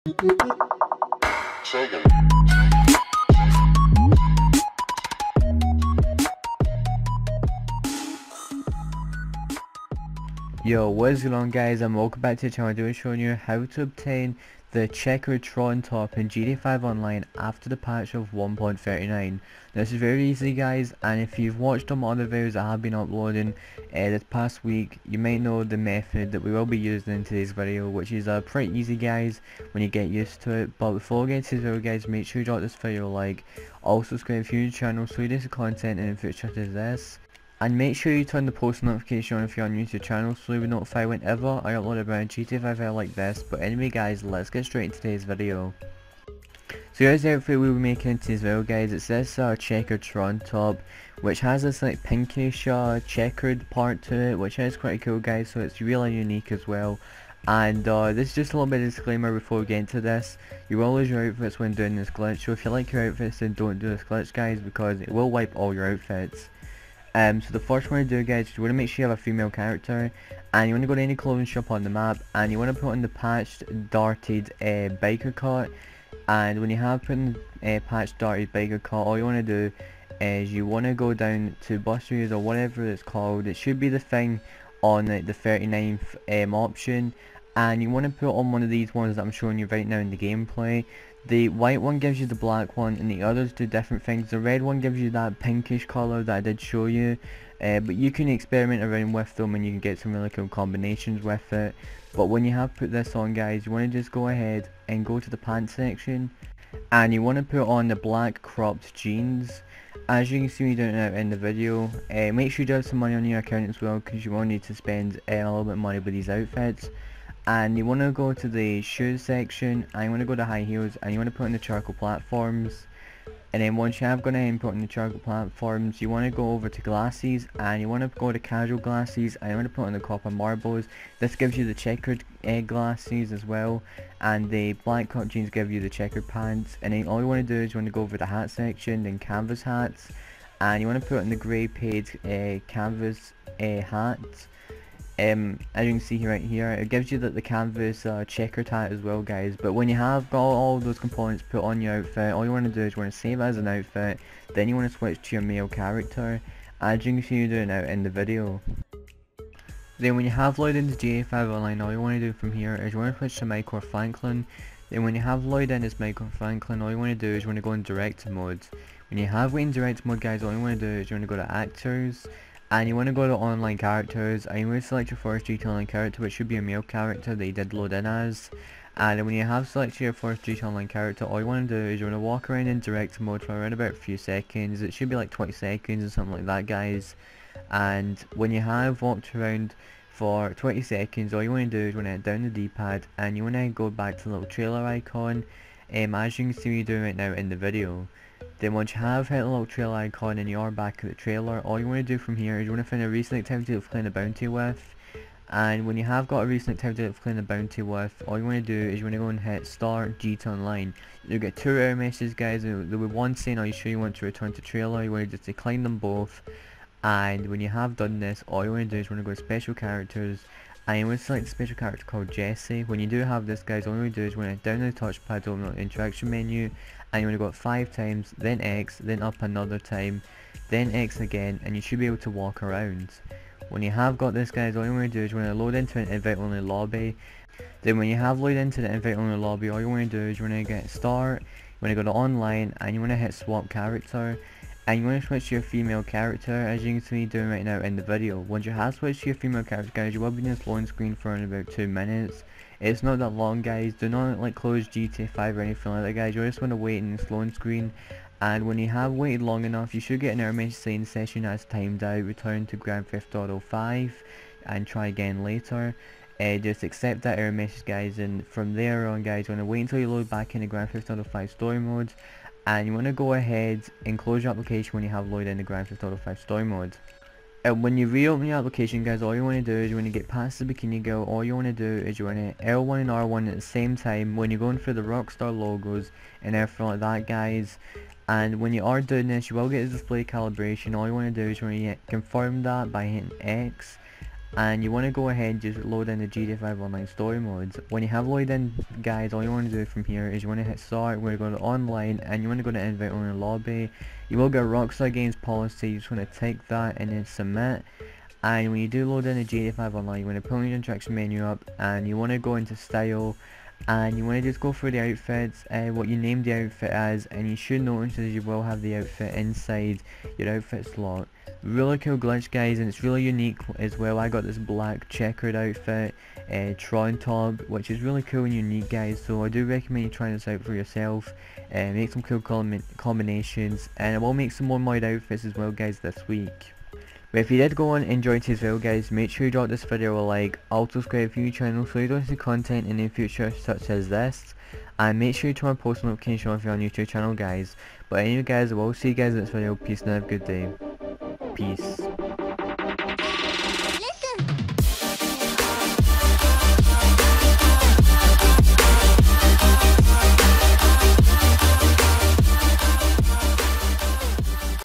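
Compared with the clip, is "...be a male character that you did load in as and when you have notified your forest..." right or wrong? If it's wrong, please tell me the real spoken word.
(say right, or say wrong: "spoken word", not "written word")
wrong: "selected", not "notified".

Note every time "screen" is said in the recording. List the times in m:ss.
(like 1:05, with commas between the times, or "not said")
4:10, 4:17.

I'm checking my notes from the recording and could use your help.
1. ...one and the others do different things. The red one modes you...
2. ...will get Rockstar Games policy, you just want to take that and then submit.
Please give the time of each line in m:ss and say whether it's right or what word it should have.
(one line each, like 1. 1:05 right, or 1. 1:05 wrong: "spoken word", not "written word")
1. 1:32 wrong: "gives", not "modes"
2. 5:04 right.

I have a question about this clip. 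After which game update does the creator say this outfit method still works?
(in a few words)
1.39.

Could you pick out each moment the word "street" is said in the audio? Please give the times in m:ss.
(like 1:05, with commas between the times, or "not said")
2:55, 3:00.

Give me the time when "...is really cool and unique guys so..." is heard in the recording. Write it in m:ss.
5:27.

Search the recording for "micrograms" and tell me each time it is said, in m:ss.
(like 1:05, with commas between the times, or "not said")
not said.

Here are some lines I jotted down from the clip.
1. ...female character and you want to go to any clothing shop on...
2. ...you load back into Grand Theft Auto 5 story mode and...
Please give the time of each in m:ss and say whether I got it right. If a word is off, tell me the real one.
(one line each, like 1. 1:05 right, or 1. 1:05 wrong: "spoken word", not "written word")
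1. 1:09 right
2. 4:29 right.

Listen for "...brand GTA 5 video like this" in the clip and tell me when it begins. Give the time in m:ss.
0:42.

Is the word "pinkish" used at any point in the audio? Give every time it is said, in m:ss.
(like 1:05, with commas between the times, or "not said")
0:52, 1:35.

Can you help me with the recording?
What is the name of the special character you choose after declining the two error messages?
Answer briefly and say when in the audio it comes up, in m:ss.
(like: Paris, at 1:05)
Jesse, at 3:42.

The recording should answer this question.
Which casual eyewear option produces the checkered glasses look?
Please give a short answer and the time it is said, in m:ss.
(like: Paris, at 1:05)
copper marbles, at 2:09.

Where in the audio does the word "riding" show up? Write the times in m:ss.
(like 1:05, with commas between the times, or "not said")
not said.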